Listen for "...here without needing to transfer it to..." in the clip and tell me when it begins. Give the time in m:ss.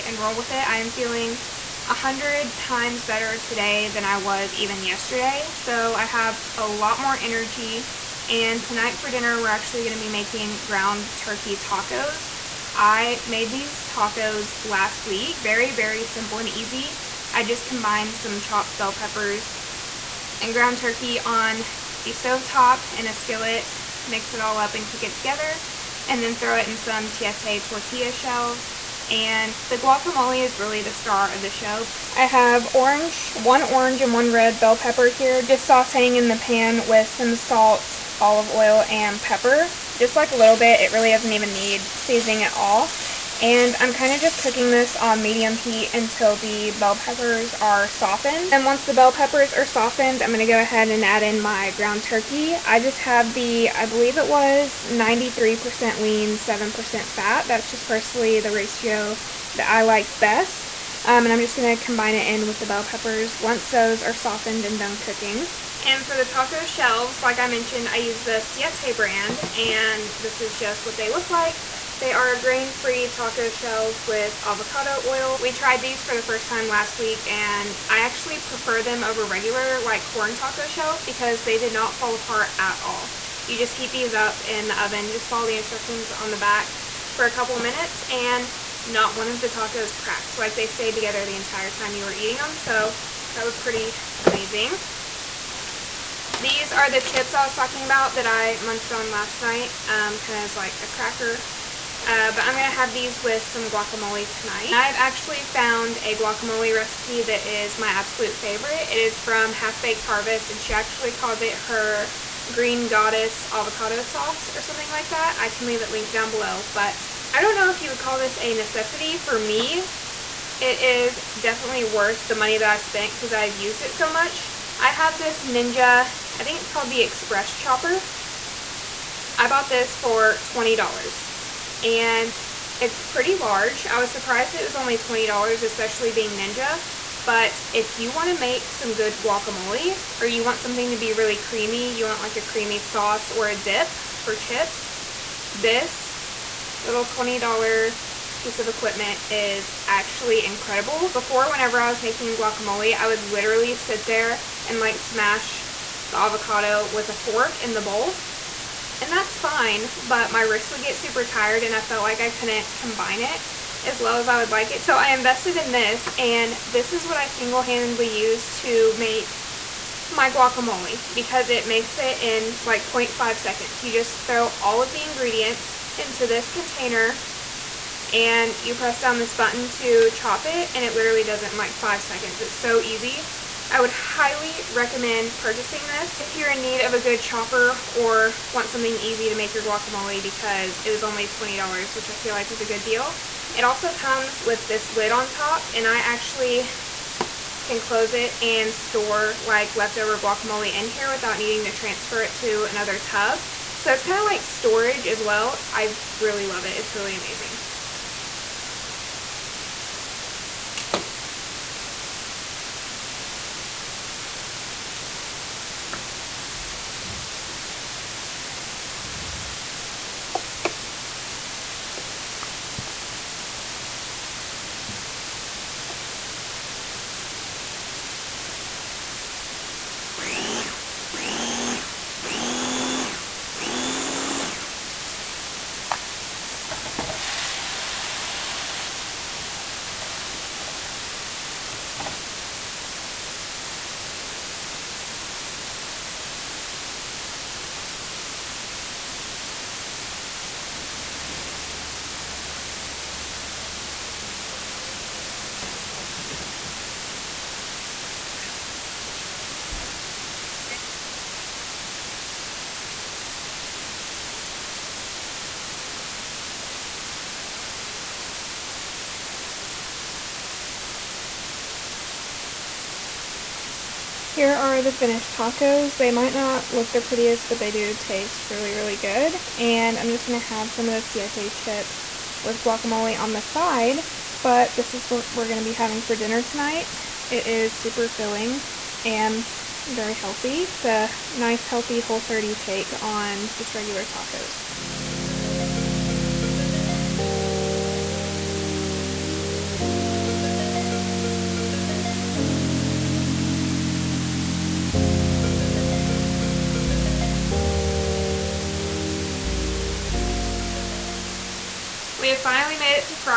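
3:20.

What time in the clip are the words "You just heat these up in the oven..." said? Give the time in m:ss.
1:23.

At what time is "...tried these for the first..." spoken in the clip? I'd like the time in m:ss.
1:15.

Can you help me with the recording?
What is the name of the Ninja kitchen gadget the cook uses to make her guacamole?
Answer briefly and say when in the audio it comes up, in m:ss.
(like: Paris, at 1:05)
Express Chopper, at 2:07.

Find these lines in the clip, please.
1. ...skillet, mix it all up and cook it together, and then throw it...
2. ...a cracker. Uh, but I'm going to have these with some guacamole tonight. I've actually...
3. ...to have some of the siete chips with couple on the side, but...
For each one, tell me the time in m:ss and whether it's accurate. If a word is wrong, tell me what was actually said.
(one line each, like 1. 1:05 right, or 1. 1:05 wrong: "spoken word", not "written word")
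1. 0:23 right
2. 1:40 right
3. 4:40 wrong: "guacamole", not "couple".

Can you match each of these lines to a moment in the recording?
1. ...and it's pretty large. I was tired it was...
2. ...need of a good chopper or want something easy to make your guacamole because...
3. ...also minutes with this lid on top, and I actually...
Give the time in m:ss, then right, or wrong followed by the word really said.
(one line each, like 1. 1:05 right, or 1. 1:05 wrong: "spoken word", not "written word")
1. 2:11 wrong: "surprised", not "tired"
2. 3:06 right
3. 3:13 wrong: "comes", not "minutes".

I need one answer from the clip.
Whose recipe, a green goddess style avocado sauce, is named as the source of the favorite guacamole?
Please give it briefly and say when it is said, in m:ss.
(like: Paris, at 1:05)
Half Baked Harvest, at 1:49.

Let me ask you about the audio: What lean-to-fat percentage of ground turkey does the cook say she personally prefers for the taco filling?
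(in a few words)
93% lean, 7% fat.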